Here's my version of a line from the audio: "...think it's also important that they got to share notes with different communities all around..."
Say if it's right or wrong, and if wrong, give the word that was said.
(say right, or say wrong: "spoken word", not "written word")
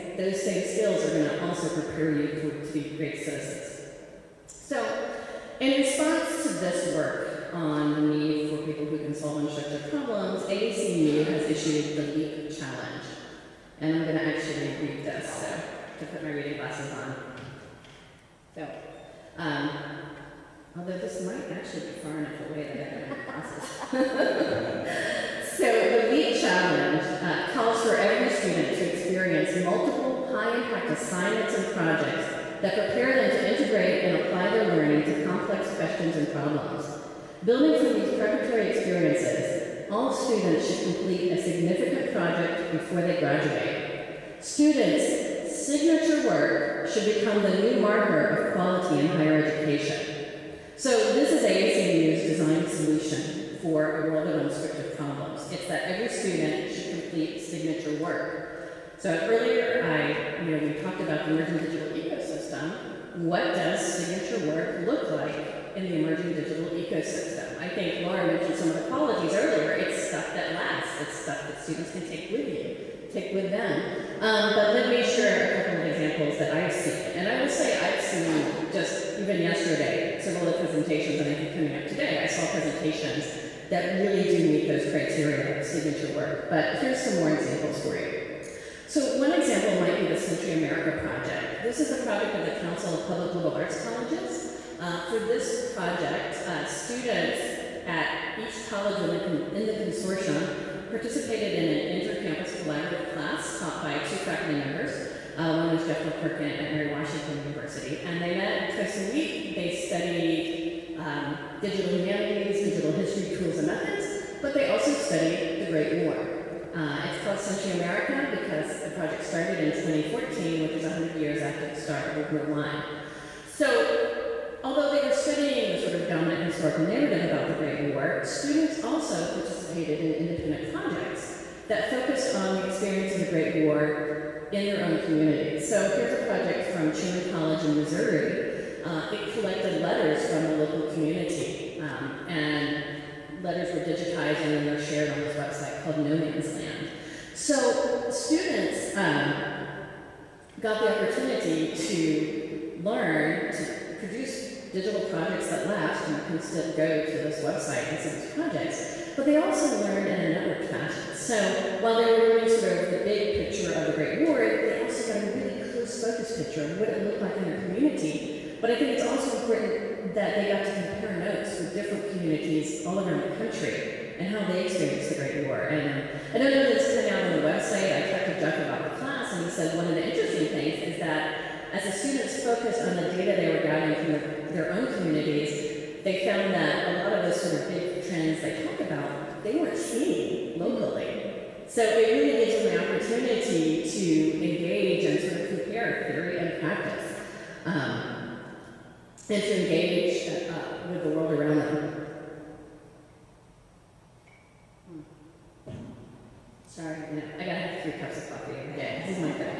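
wrong: "compare", not "share".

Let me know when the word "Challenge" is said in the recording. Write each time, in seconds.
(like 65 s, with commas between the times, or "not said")
12 s, 26 s.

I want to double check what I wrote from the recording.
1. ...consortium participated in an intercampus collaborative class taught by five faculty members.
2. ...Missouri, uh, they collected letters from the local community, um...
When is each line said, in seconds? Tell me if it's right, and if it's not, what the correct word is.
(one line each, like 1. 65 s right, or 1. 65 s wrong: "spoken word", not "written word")
1. 99 s wrong: "two", not "five"
2. 137 s right.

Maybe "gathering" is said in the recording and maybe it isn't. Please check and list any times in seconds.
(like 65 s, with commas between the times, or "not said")
183 s.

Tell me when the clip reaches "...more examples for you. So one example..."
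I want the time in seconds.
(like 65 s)
87 s.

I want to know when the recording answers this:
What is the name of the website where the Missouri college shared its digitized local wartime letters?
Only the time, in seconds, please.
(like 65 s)
146 s.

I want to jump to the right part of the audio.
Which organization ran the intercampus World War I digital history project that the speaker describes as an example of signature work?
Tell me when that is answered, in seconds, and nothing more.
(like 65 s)
92 s.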